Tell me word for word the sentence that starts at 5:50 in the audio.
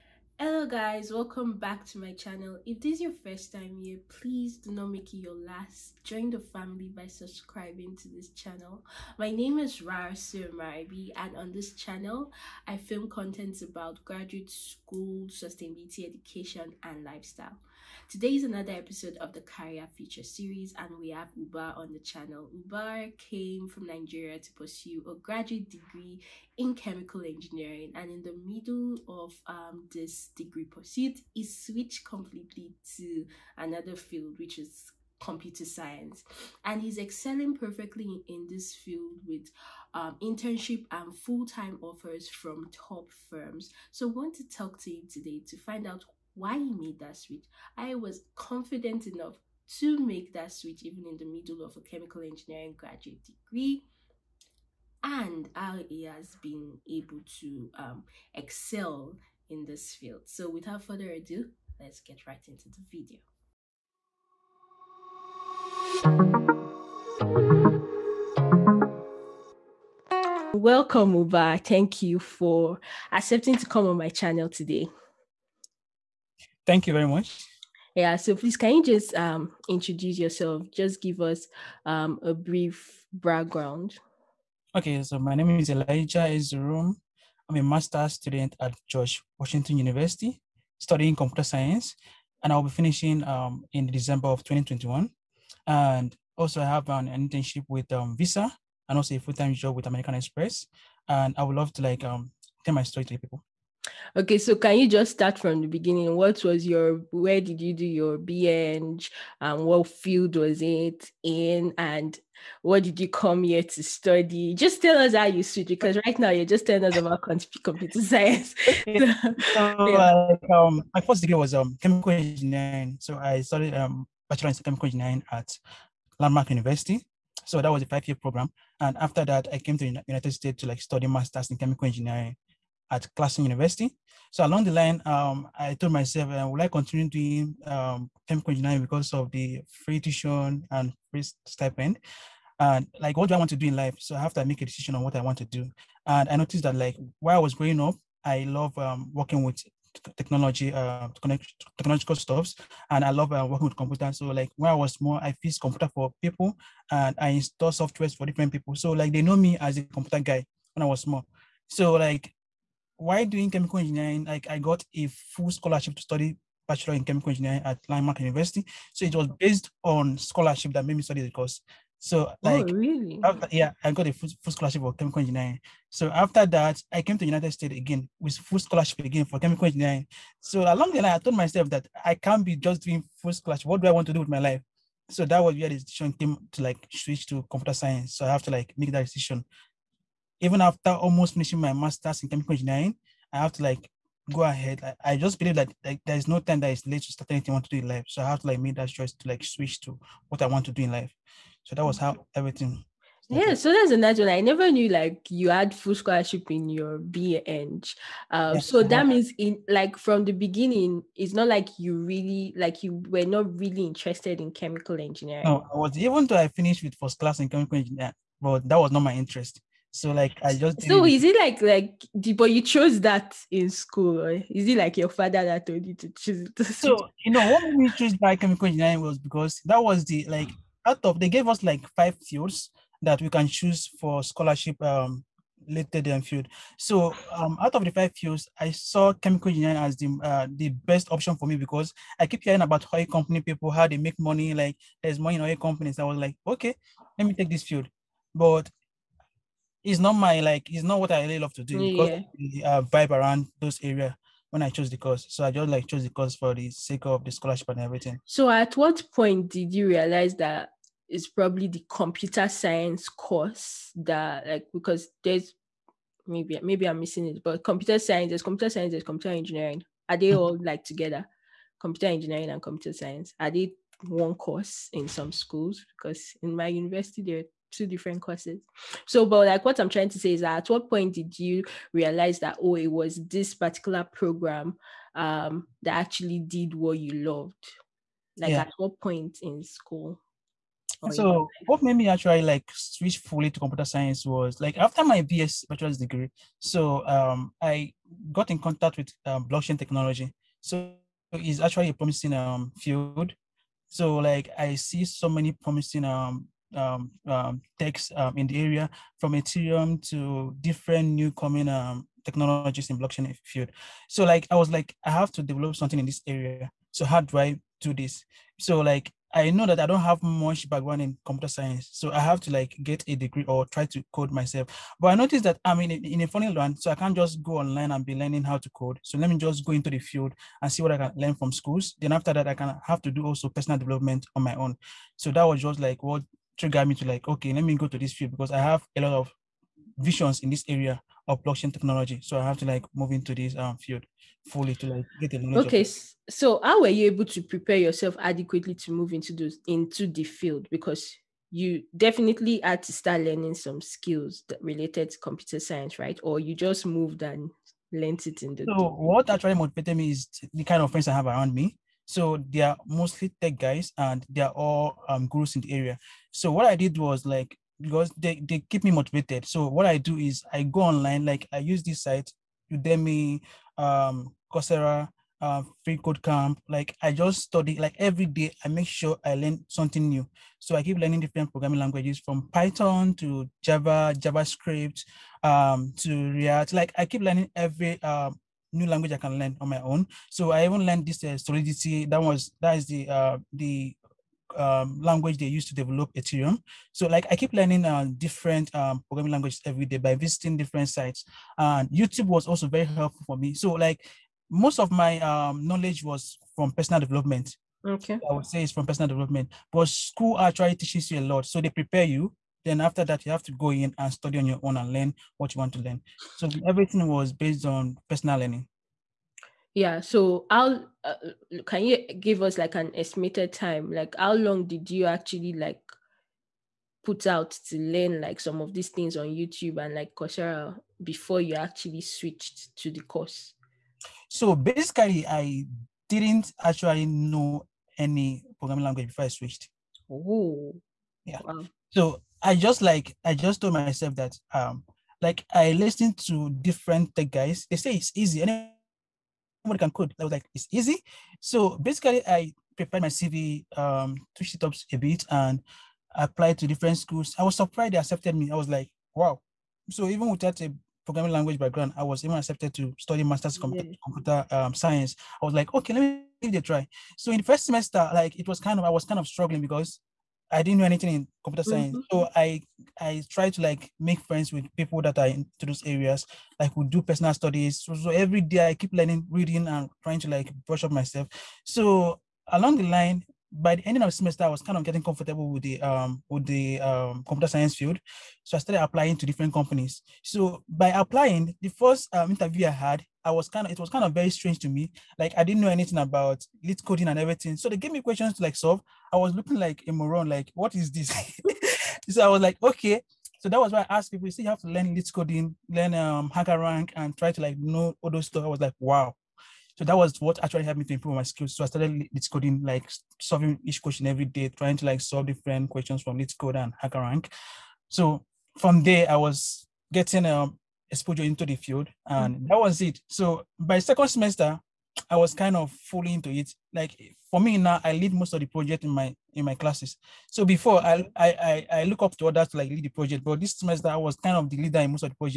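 Because you definitely had to start learning some skills that related to computer science, right?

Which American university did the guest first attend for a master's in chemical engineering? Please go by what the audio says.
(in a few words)
Clarkson University.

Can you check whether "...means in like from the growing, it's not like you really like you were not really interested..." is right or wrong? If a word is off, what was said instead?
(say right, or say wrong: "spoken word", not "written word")
wrong: "beginning", not "growing".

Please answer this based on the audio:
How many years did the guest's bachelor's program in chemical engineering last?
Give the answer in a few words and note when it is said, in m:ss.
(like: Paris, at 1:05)
5, at 2:07.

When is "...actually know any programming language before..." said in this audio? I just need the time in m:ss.
7:16.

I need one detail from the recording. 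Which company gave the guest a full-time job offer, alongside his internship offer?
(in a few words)
American Express.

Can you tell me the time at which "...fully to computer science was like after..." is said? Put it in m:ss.
4:53.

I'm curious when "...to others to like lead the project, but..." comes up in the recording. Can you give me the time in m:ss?
8:52.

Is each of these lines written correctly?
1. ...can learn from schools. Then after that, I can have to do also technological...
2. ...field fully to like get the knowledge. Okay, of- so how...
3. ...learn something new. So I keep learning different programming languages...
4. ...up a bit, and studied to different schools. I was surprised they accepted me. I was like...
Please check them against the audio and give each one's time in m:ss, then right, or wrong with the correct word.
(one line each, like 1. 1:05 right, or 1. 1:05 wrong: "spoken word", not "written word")
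1. 5:30 wrong: "personal", not "technological"
2. 5:43 right
3. 6:19 right
4. 7:34 wrong: "applied", not "studied".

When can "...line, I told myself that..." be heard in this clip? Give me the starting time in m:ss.
3:01.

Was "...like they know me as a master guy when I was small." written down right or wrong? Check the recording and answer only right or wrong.
wrong.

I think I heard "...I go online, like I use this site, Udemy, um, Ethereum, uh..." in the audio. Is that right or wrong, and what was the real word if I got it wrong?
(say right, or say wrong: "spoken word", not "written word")
wrong: "Coursera", not "Ethereum".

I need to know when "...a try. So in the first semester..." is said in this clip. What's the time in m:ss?
7:46.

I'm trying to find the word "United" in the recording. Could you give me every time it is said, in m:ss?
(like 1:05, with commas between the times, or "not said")
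2:10, 2:57.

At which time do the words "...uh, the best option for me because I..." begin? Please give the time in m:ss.
4:00.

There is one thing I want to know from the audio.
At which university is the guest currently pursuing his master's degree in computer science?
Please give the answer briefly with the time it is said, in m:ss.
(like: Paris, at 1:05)
George Washington University, at 1:28.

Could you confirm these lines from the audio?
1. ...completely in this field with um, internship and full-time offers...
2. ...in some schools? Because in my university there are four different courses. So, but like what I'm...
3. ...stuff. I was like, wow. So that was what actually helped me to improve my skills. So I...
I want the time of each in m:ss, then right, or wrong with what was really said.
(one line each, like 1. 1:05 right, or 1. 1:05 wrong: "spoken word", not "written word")
1. 0:37 wrong: "perfectly", not "completely"
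2. 4:34 wrong: "two", not "four"
3. 8:28 right.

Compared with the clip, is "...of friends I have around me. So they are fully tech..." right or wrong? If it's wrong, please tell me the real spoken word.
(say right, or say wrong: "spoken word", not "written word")
wrong: "mostly", not "fully".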